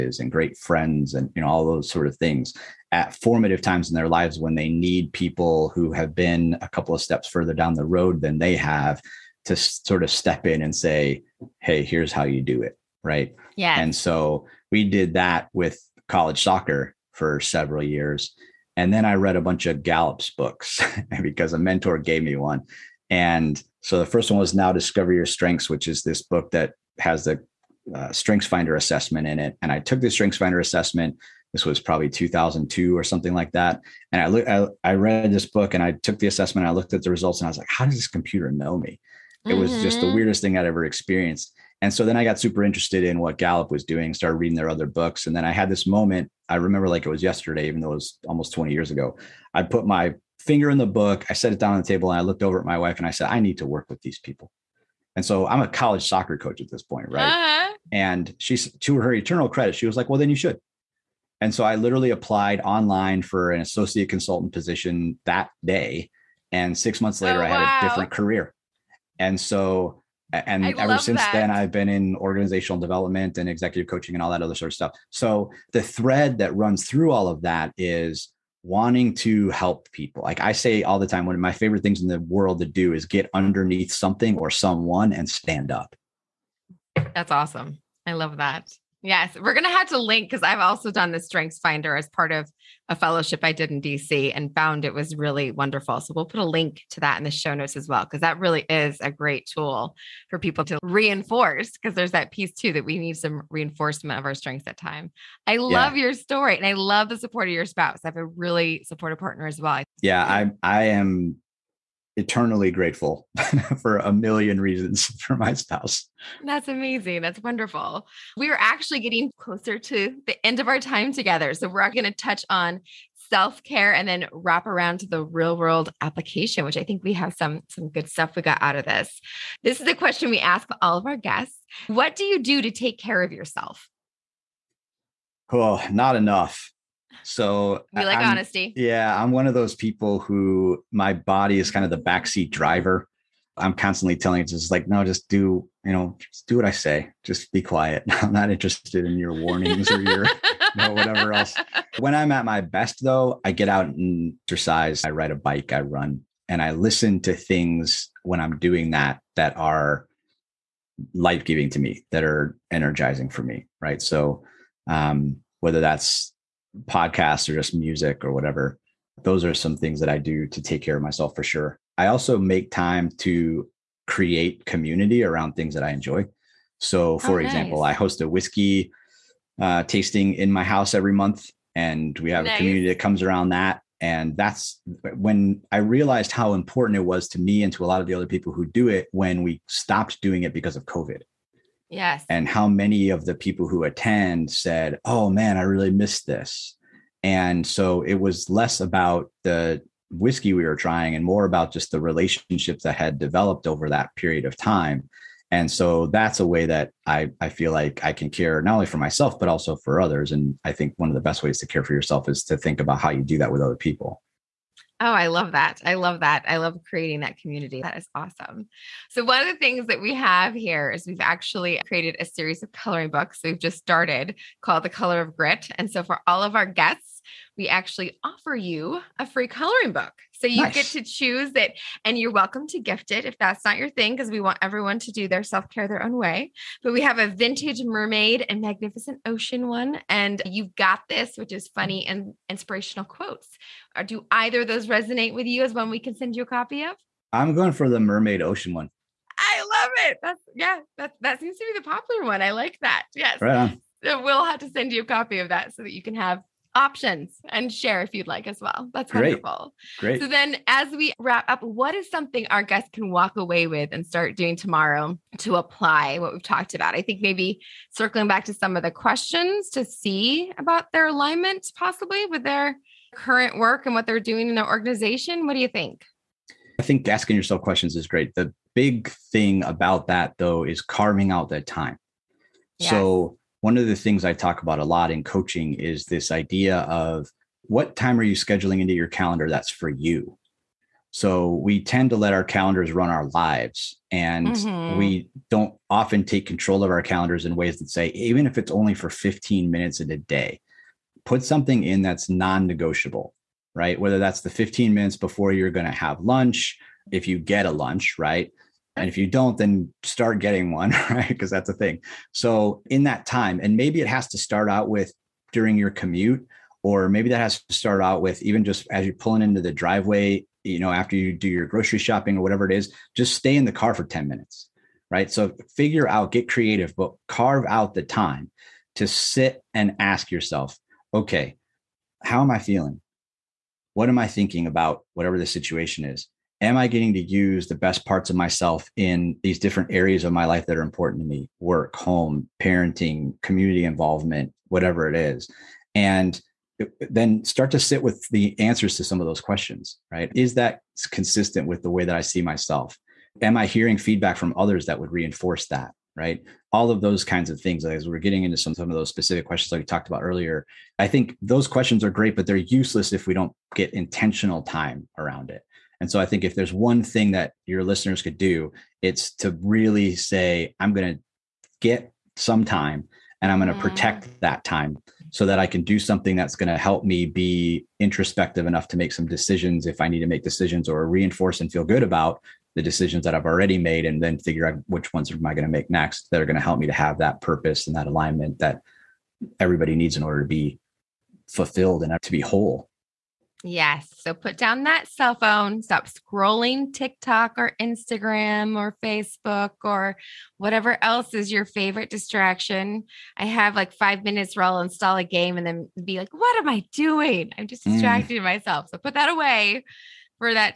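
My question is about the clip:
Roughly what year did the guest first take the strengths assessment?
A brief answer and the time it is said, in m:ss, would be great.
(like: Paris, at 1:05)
2002, at 0:32.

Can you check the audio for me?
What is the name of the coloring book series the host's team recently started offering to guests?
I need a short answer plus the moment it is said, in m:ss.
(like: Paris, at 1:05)
The Color of Grit, at 3:44.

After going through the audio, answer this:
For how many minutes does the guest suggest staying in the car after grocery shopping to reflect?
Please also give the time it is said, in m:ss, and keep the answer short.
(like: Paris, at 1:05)
10, at 5:24.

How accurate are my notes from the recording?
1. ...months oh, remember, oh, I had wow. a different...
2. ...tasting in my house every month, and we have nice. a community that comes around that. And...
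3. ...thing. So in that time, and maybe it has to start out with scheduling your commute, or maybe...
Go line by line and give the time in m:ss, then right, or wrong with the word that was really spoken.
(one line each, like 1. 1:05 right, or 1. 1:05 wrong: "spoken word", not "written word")
1. 1:07 wrong: "later", not "remember"
2. 2:59 right
3. 5:11 wrong: "during", not "scheduling".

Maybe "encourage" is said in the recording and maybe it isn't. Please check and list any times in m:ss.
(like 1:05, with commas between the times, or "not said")
not said.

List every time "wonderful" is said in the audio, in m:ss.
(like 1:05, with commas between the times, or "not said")
1:35, 1:57, 4:19.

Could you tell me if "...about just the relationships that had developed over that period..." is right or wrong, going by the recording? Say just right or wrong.
right.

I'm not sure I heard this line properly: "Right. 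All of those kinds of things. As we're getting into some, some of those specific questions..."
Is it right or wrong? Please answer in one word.
right.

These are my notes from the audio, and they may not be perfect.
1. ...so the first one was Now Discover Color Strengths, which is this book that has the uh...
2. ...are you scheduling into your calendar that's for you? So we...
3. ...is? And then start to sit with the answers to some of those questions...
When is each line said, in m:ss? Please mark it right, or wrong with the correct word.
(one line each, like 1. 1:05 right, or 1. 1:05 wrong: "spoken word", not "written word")
1. 0:23 wrong: "Your", not "Color"
2. 4:48 right
3. 5:45 right.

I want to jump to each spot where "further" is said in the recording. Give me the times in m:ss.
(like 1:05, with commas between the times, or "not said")
0:07.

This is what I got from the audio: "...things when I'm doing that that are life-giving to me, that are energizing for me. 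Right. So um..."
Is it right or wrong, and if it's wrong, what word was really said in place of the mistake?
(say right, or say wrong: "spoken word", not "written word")
right.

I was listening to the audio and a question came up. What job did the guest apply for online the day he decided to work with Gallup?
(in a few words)
associate consultant.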